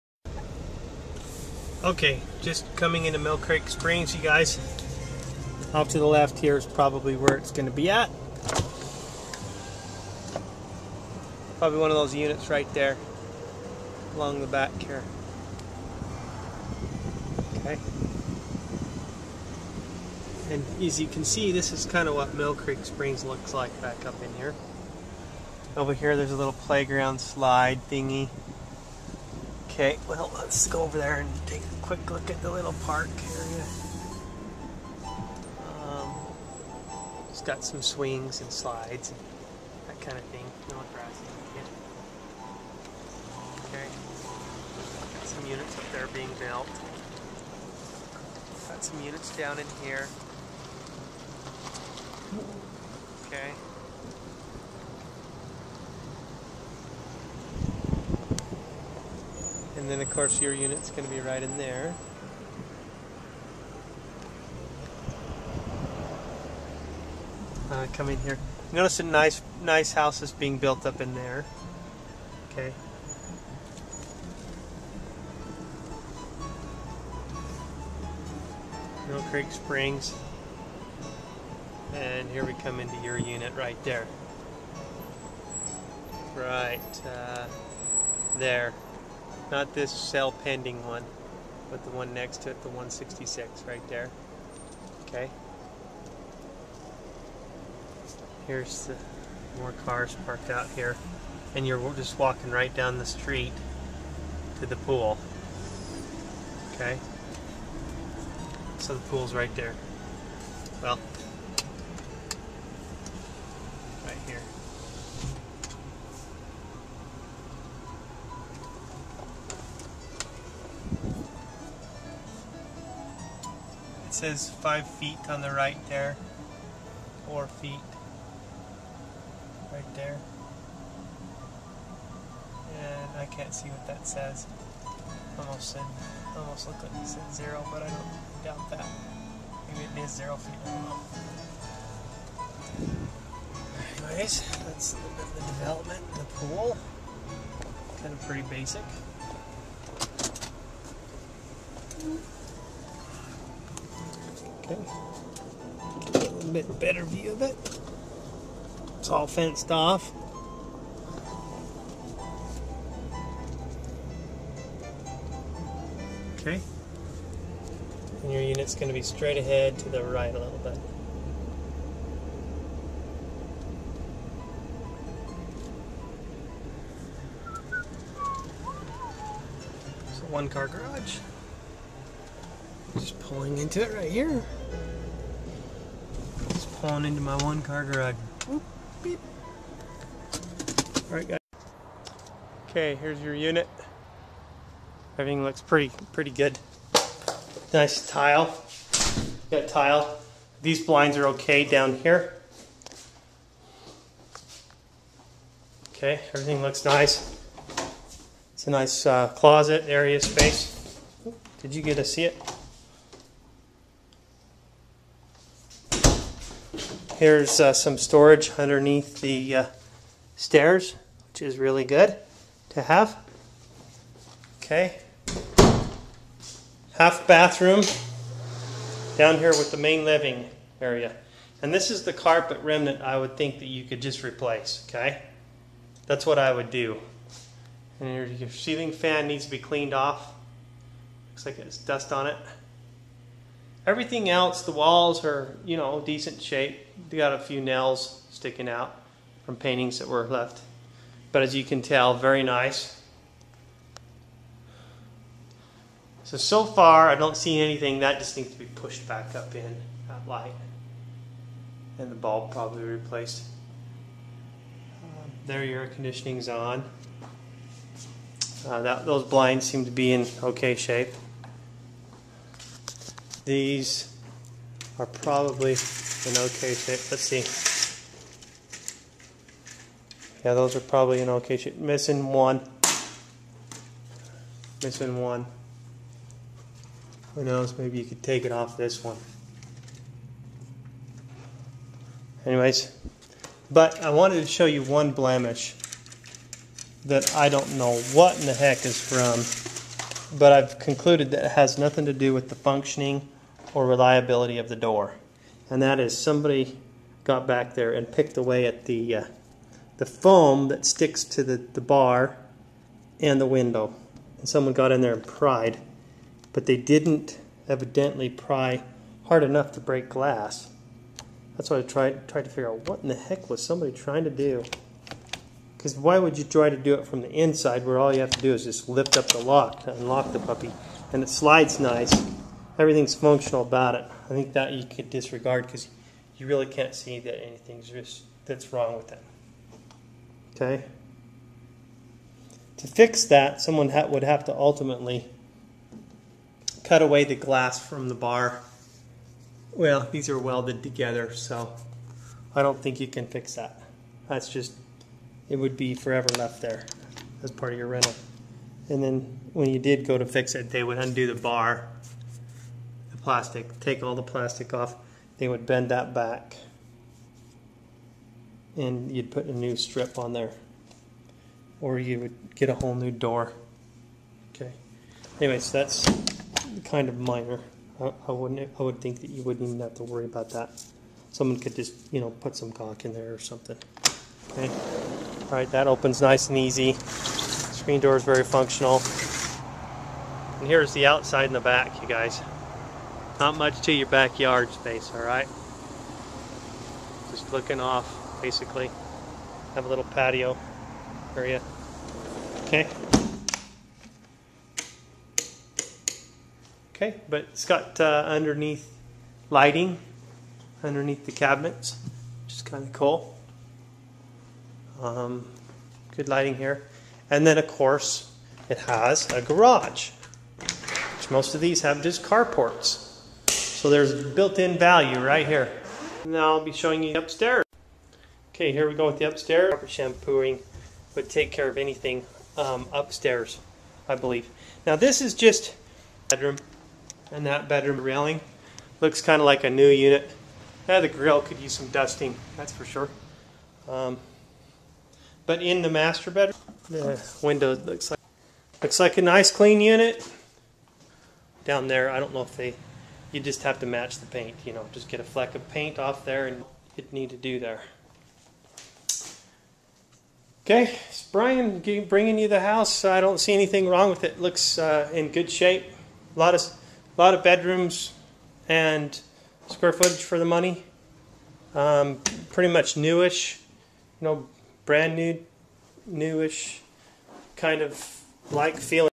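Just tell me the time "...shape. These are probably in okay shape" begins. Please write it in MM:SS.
04:30.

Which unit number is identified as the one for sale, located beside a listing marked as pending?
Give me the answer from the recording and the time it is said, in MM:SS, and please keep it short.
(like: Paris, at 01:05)
166, at 01:32.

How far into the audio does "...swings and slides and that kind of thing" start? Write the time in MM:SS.
00:37.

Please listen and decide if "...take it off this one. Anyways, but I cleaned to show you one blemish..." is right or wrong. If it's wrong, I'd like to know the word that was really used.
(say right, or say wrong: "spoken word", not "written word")
wrong: "wanted", not "cleaned".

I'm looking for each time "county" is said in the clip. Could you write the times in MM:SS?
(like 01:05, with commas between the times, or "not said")
not said.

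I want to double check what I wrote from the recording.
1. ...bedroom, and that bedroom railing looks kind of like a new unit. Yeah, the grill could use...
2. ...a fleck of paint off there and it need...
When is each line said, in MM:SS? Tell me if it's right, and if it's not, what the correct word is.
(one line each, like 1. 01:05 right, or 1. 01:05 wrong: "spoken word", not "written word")
1. 07:16 right
2. 07:35 right.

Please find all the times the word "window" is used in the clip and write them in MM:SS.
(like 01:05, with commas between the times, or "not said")
05:13, 07:27.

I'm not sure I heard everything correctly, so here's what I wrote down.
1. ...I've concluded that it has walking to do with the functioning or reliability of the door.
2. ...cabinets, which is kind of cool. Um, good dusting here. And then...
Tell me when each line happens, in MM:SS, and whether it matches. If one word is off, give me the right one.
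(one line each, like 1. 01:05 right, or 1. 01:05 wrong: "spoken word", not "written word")
1. 05:00 wrong: "nothing", not "walking"
2. 06:51 wrong: "lighting", not "dusting".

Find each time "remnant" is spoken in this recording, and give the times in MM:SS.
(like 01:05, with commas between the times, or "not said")
03:52.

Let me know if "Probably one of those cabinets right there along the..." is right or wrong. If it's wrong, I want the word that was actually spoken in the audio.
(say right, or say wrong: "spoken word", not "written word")
wrong: "units", not "cabinets".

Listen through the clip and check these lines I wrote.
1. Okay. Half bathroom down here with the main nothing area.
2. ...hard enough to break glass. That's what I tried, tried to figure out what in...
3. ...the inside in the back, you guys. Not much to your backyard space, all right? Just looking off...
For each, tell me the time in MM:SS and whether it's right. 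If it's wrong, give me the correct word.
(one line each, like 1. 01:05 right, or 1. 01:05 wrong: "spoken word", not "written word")
1. 03:44 wrong: "living", not "nothing"
2. 05:19 right
3. 06:30 wrong: "outside", not "inside".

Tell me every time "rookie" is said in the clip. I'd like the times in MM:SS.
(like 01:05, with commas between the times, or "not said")
not said.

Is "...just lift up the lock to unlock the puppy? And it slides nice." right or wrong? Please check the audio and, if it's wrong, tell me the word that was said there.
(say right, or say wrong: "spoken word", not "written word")
right.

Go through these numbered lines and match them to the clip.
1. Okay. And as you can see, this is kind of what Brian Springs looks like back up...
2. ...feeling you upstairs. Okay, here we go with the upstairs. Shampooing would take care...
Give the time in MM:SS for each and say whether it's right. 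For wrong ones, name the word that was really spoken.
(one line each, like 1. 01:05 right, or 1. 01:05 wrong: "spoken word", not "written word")
1. 00:17 wrong: "Millcreek", not "Brian"
2. 07:06 wrong: "showing", not "feeling".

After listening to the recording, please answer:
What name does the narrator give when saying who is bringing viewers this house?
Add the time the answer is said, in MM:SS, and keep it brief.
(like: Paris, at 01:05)
Brian, at 07:41.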